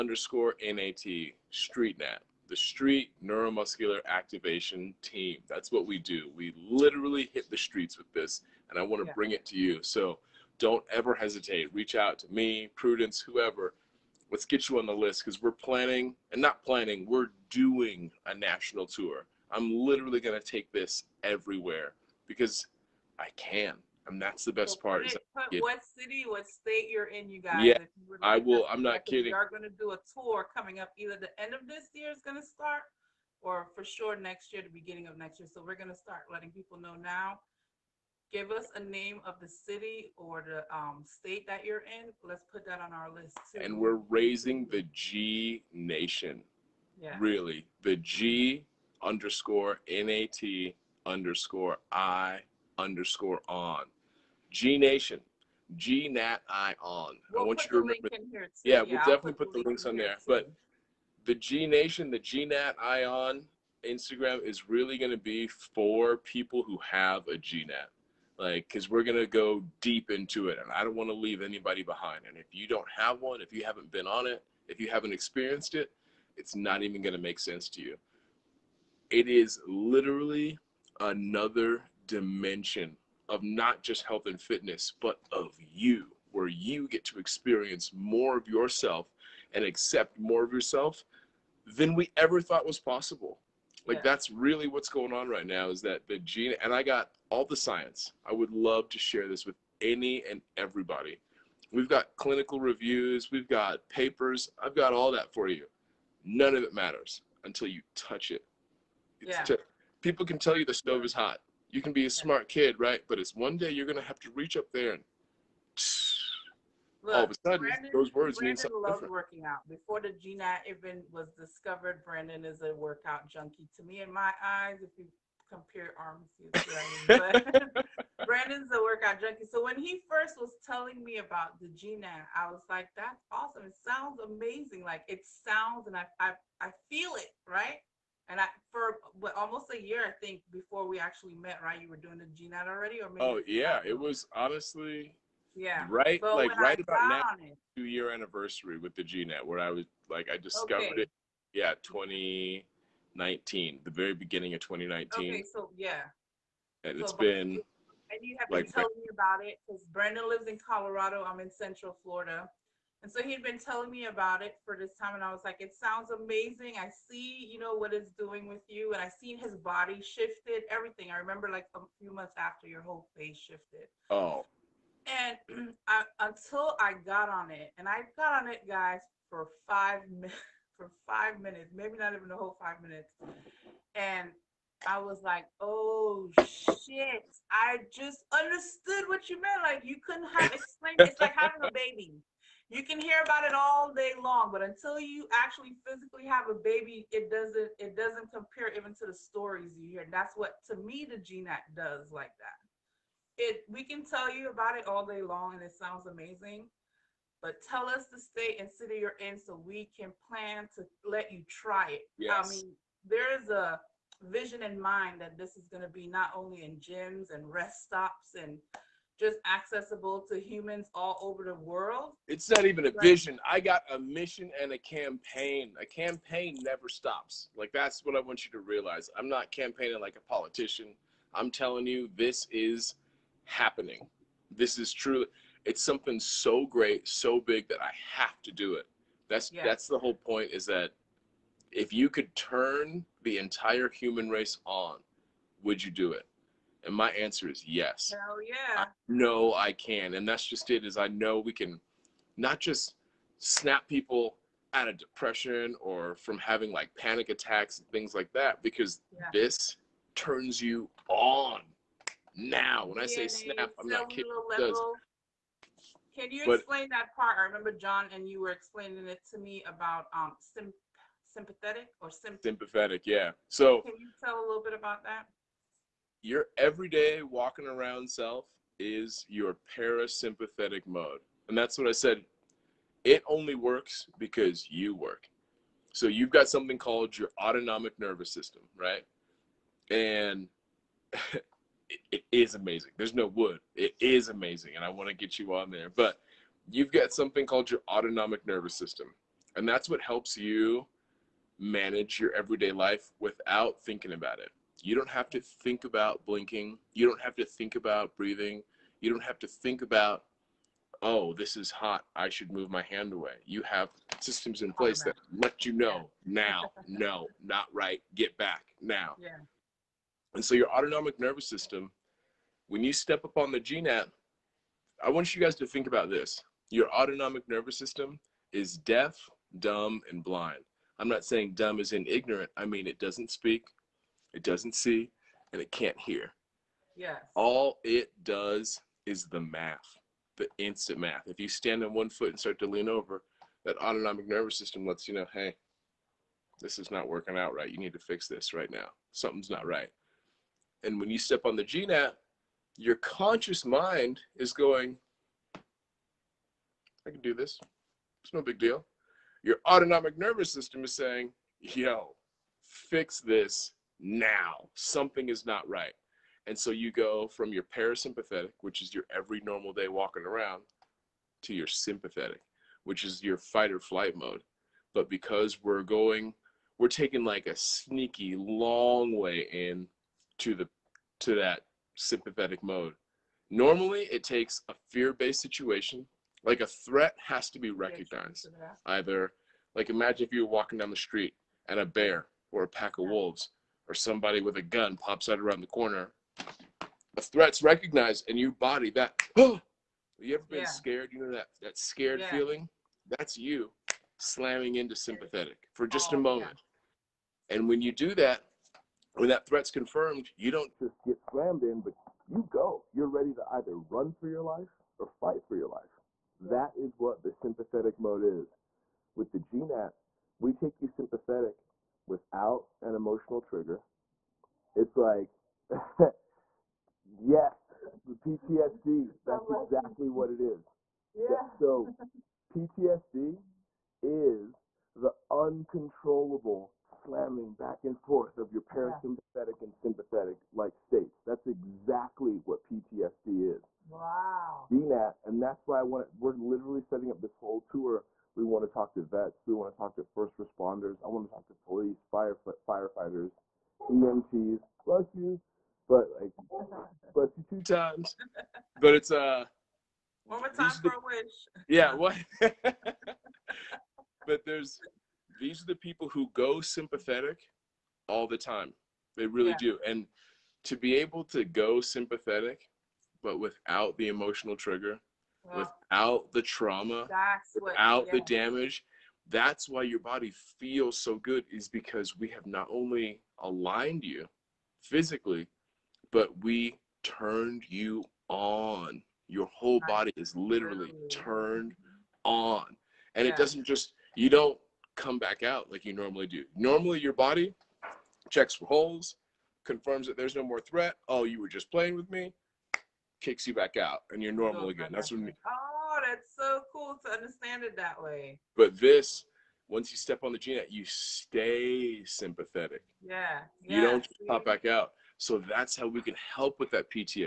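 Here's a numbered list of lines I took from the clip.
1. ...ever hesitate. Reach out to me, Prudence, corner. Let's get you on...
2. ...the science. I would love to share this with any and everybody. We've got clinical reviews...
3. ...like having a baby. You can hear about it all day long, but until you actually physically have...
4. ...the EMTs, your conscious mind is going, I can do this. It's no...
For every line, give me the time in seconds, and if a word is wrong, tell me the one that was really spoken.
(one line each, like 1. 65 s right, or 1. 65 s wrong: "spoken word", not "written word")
1. 10 s wrong: "whoever", not "corner"
2. 97 s right
3. 191 s right
4. 351 s wrong: "GNAT", not "EMTs".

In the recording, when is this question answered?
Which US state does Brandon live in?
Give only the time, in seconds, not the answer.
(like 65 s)
160 s.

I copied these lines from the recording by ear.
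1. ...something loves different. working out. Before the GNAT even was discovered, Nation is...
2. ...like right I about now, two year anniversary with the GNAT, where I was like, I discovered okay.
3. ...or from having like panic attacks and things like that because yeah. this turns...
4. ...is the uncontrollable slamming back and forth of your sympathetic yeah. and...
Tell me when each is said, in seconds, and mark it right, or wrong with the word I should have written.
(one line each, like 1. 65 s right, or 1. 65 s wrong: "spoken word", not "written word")
1. 118 s wrong: "Brandon", not "Nation"
2. 146 s right
3. 255 s right
4. 434 s wrong: "parasympathetic", not "sympathetic".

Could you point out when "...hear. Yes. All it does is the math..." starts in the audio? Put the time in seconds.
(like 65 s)
335 s.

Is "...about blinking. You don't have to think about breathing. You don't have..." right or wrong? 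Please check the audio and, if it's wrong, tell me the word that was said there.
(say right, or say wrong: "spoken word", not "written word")
right.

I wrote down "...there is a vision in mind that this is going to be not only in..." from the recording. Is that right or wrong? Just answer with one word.
right.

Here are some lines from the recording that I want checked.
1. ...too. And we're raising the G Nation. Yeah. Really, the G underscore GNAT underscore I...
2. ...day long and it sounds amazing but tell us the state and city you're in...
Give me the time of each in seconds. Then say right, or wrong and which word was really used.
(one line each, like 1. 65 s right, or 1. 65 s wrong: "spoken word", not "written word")
1. 43 s wrong: "NAT", not "GNAT"
2. 205 s right.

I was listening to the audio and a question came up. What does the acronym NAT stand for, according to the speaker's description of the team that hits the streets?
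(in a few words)
Neuromuscular activation team.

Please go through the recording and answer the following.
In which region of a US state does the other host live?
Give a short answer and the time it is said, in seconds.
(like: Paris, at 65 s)
Central Florida, at 161 s.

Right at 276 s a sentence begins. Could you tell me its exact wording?
Your everyday walking around self is your parasympathetic mode, and that's what I said.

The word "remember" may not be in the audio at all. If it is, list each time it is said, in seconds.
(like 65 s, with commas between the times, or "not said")
57 s, 171 s, 267 s.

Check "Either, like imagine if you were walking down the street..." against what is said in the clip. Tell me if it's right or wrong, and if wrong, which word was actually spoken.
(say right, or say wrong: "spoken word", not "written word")
right.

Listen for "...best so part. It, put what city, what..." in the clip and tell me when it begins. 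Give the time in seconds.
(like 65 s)
24 s.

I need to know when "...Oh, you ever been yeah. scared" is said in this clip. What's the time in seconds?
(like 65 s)
400 s.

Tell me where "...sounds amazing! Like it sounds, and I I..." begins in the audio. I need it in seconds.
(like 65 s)
133 s.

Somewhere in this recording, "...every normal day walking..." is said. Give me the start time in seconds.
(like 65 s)
369 s.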